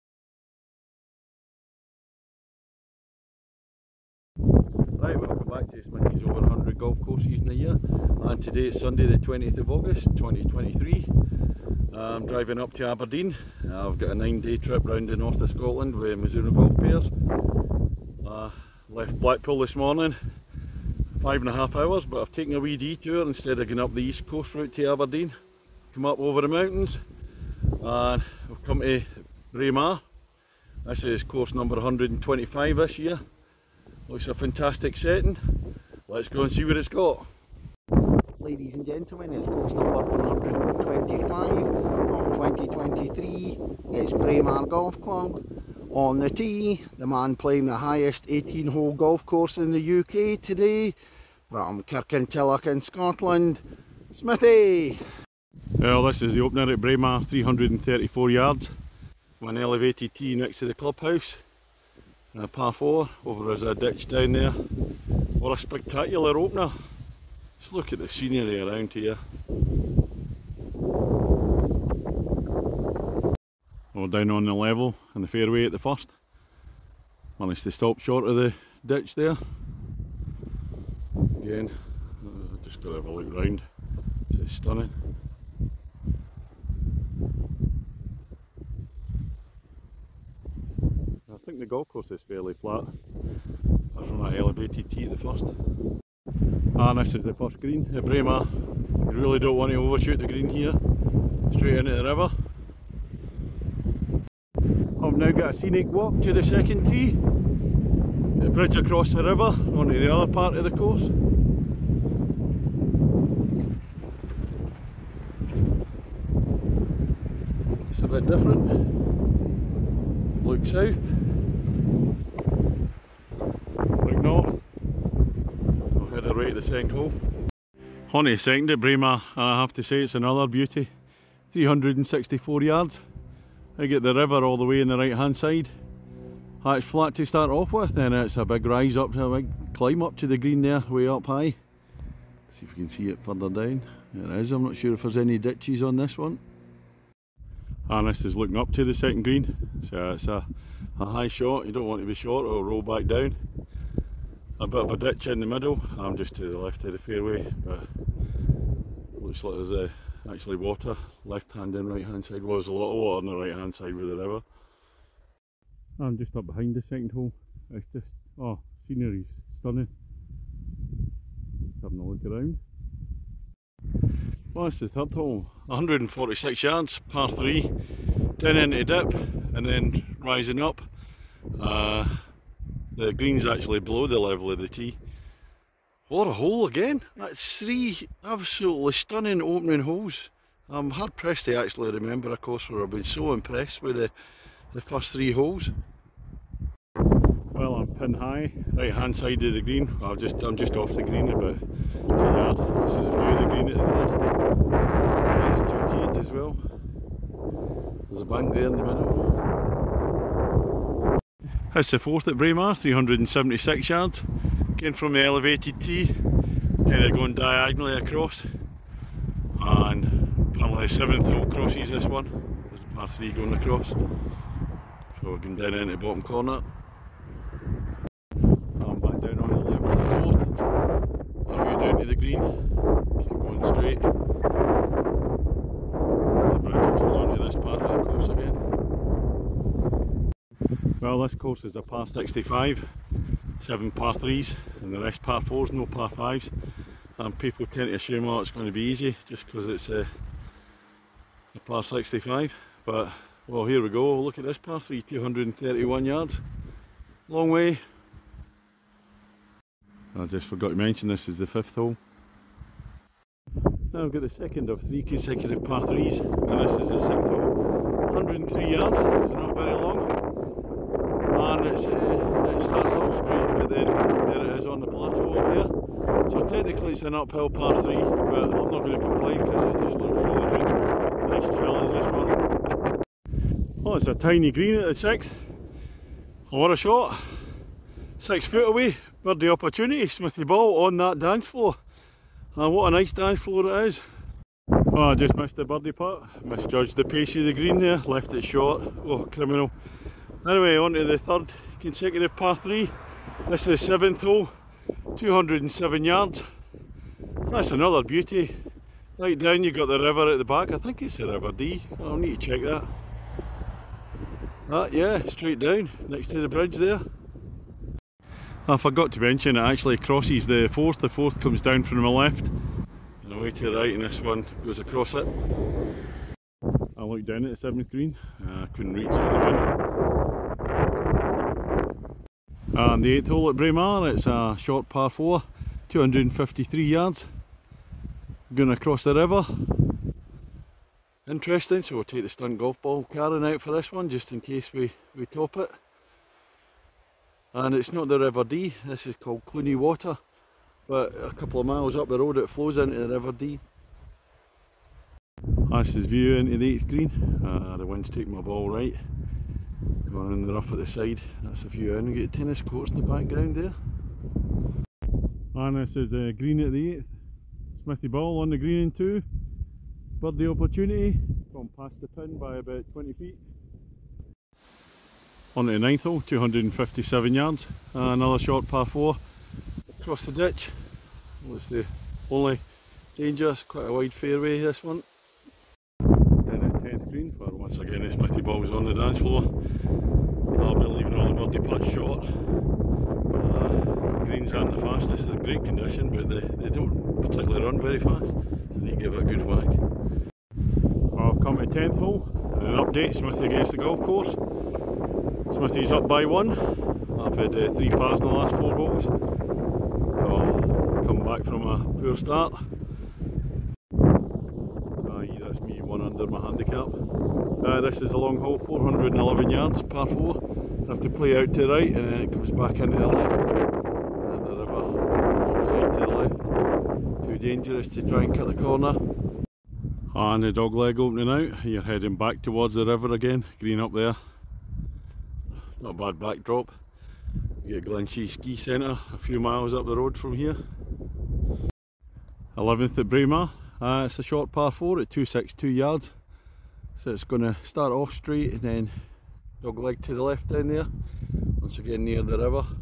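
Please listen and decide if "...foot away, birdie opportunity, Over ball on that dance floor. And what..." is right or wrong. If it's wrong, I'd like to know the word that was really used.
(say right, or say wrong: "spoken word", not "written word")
wrong: "Smithy", not "Over".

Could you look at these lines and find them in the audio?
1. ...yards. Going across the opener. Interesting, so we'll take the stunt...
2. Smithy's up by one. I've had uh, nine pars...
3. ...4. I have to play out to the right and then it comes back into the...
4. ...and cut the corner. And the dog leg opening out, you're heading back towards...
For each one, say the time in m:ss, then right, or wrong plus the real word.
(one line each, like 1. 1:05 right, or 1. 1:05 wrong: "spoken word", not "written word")
1. 5:36 wrong: "river", not "opener"
2. 6:45 wrong: "three", not "nine"
3. 7:00 right
4. 7:08 right.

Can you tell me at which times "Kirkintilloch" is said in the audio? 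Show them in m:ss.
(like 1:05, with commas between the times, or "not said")
0:51.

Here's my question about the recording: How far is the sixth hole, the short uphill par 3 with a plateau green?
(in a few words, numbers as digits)
103 yards.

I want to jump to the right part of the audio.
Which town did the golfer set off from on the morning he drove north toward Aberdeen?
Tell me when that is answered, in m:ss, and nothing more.
0:19.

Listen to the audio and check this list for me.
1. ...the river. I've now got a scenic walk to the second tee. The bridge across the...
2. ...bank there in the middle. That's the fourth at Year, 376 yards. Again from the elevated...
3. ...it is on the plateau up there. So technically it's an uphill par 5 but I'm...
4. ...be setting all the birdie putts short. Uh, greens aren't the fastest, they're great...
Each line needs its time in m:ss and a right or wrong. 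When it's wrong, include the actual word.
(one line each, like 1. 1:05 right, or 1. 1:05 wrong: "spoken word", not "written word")
1. 1:41 right
2. 3:28 wrong: "Braemar", not "Year"
3. 4:34 wrong: "3", not "5"
4. 6:30 wrong: "leaving", not "setting".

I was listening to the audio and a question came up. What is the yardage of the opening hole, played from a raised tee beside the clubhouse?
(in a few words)
334 yards.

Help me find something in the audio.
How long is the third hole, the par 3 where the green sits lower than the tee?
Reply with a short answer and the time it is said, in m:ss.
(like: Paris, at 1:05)
146 yards, at 2:55.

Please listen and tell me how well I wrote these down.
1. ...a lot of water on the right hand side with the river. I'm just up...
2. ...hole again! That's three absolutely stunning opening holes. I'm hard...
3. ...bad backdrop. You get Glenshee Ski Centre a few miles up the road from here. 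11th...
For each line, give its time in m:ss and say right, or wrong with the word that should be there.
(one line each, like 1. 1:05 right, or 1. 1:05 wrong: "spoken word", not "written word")
1. 2:42 right
2. 3:06 right
3. 7:15 right.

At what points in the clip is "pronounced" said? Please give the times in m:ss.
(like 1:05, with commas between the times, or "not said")
not said.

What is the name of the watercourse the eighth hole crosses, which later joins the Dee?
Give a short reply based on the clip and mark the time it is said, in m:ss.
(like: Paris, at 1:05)
Clunie Water, at 5:49.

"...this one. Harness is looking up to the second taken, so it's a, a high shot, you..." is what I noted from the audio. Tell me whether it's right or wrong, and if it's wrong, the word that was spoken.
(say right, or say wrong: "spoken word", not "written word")
wrong: "green", not "taken".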